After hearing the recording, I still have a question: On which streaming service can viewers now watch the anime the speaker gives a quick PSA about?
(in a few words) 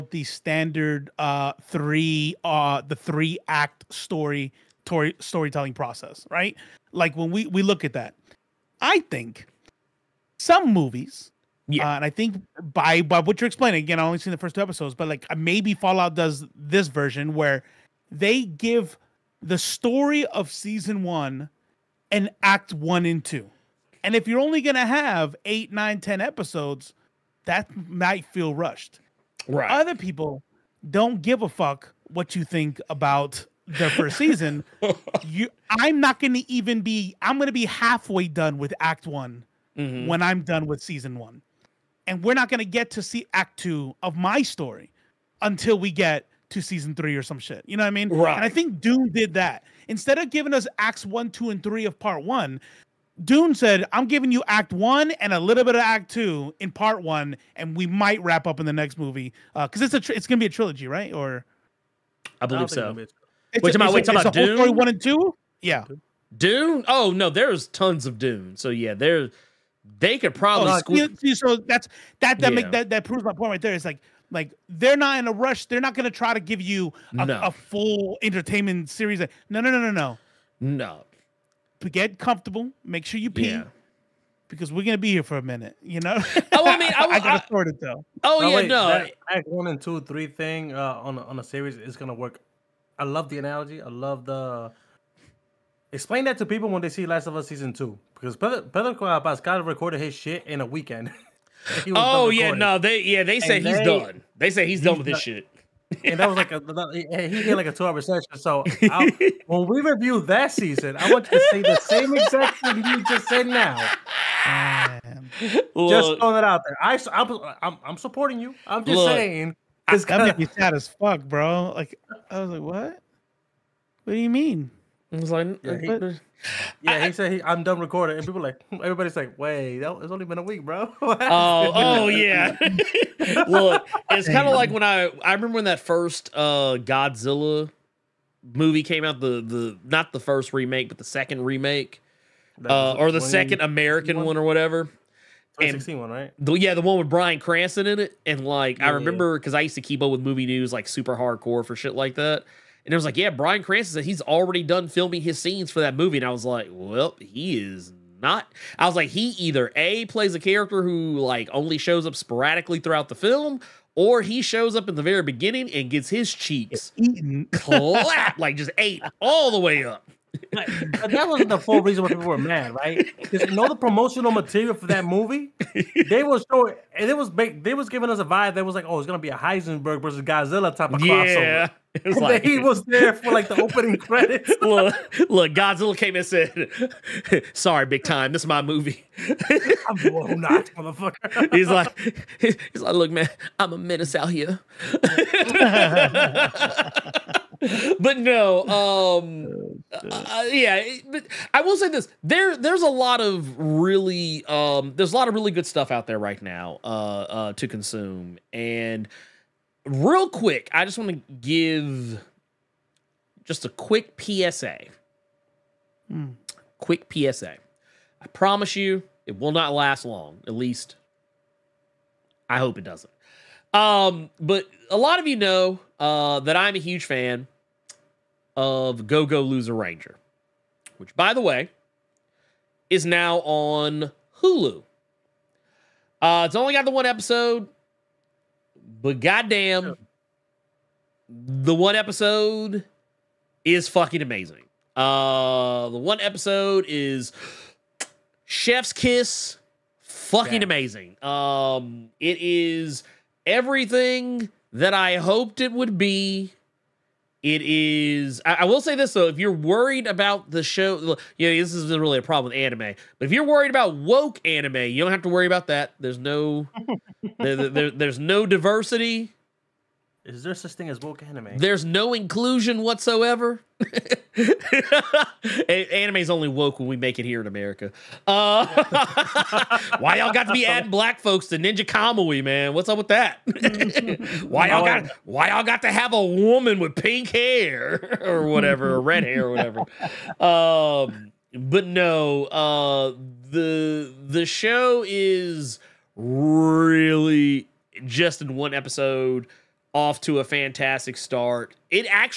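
Hulu.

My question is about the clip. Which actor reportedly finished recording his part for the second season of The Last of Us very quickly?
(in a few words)
Pedro Pascal.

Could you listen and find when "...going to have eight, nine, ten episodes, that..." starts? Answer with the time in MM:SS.
00:24.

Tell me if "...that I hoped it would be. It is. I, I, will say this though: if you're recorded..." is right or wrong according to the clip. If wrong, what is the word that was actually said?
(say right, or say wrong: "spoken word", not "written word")
wrong: "worried", not "recorded".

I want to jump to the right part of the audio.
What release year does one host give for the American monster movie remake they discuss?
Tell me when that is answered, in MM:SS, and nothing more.
02:25.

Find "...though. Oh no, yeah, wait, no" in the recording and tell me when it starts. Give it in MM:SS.
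01:27.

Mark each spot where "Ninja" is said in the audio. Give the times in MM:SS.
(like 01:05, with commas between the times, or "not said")
04:41.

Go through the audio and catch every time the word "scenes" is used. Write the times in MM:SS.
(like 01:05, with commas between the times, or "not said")
02:35.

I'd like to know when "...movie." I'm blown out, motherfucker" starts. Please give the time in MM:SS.
03:08.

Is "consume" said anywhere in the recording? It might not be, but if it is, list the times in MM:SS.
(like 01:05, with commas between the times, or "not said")
03:27.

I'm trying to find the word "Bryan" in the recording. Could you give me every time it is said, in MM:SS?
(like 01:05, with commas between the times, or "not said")
02:27, 02:33.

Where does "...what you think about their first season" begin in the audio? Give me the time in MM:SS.
00:32.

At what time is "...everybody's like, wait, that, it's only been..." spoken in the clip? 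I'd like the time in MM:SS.
02:08.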